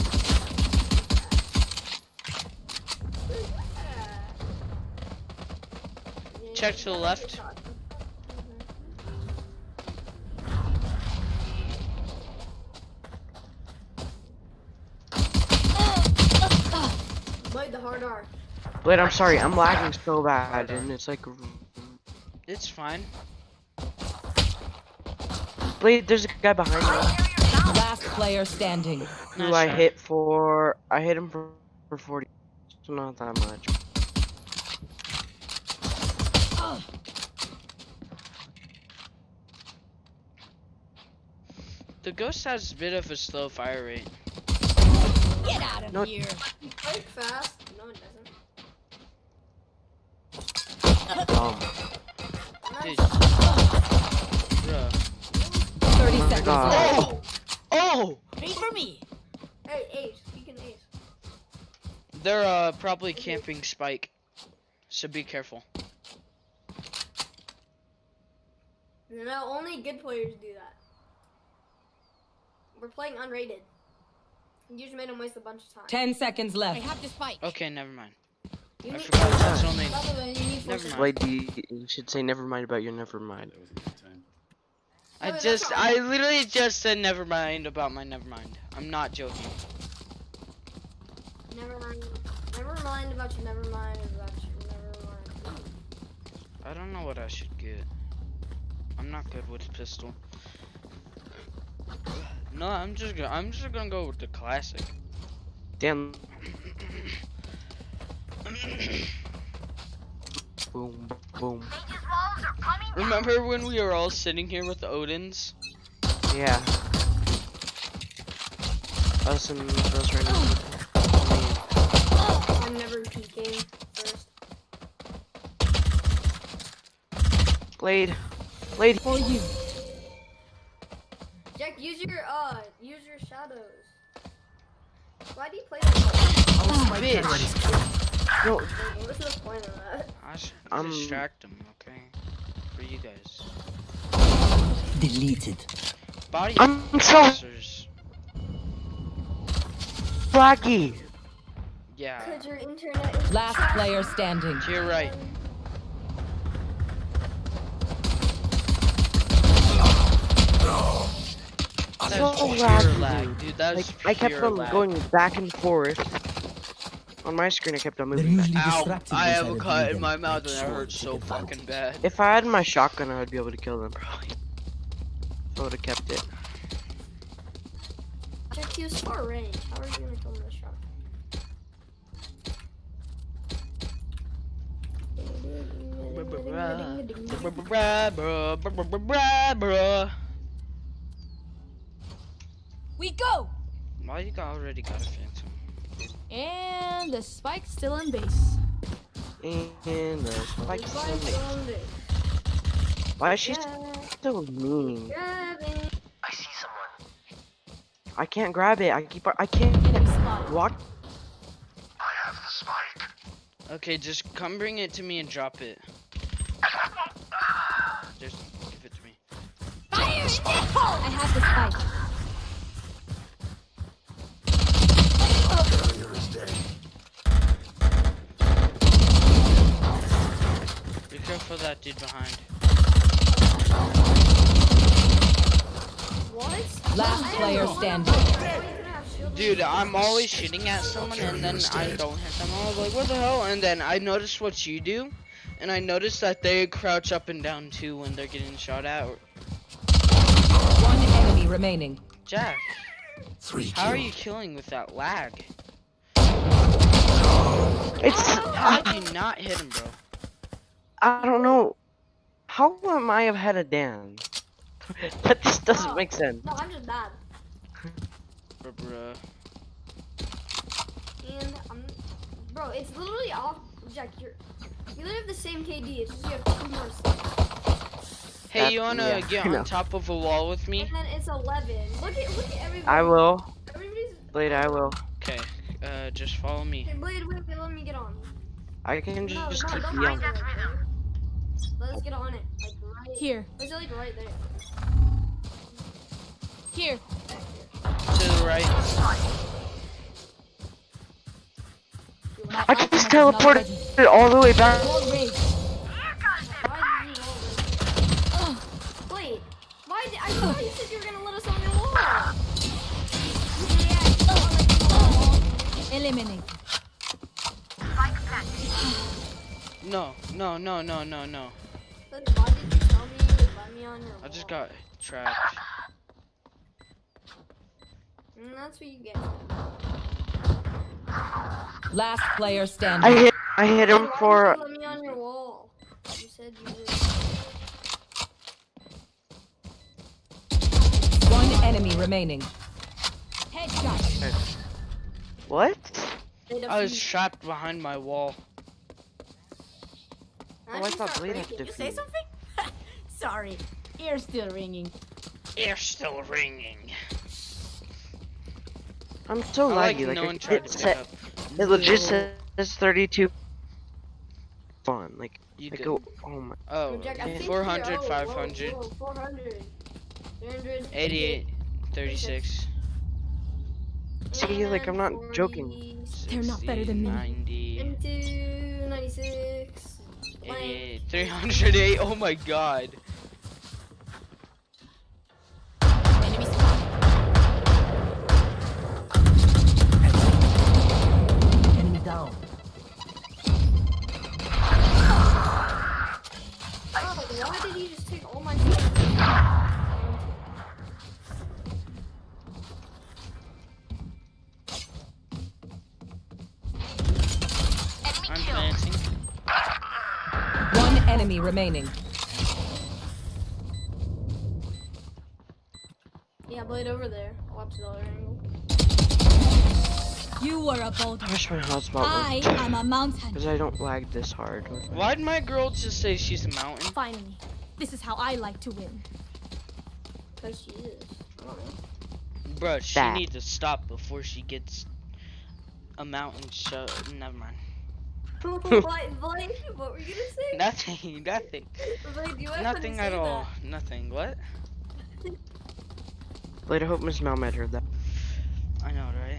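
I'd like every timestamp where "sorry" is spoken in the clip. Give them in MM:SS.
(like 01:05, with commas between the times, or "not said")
00:19, 05:53.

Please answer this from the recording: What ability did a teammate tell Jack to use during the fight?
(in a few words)
shadows.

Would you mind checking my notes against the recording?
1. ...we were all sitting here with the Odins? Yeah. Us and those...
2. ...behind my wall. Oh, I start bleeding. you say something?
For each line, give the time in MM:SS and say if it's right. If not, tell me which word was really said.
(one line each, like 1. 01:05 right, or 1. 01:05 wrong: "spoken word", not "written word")
1. 01:53 right
2. 05:47 right.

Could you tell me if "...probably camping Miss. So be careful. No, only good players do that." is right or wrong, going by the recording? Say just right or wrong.
wrong.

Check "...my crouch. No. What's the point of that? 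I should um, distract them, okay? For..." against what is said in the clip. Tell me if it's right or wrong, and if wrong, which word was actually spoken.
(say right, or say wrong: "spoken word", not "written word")
wrong: "bitch", not "crouch".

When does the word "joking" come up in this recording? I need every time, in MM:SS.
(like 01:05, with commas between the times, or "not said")
01:29, 06:15.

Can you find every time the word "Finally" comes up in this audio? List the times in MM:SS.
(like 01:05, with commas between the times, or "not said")
07:06.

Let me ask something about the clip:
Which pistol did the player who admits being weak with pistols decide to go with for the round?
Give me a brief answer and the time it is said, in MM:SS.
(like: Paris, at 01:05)
Classic, at 01:43.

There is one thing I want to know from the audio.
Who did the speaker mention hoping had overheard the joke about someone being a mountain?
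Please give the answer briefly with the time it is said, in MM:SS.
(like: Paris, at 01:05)
Miss Malmed, at 07:26.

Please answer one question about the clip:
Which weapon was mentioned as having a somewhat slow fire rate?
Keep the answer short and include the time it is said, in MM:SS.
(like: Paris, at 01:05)
Ghost, at 00:42.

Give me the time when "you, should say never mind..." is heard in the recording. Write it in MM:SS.
01:21.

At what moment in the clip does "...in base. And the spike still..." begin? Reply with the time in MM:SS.
03:17.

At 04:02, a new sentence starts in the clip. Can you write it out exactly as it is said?
I was like, what the hell?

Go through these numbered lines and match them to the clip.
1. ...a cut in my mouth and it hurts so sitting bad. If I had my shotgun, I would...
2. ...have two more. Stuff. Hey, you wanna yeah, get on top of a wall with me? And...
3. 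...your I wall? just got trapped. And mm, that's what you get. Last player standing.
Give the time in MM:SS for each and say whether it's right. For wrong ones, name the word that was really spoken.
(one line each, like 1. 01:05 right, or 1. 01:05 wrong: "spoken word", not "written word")
1. 02:49 wrong: "fucking", not "sitting"
2. 04:36 right
3. 05:24 right.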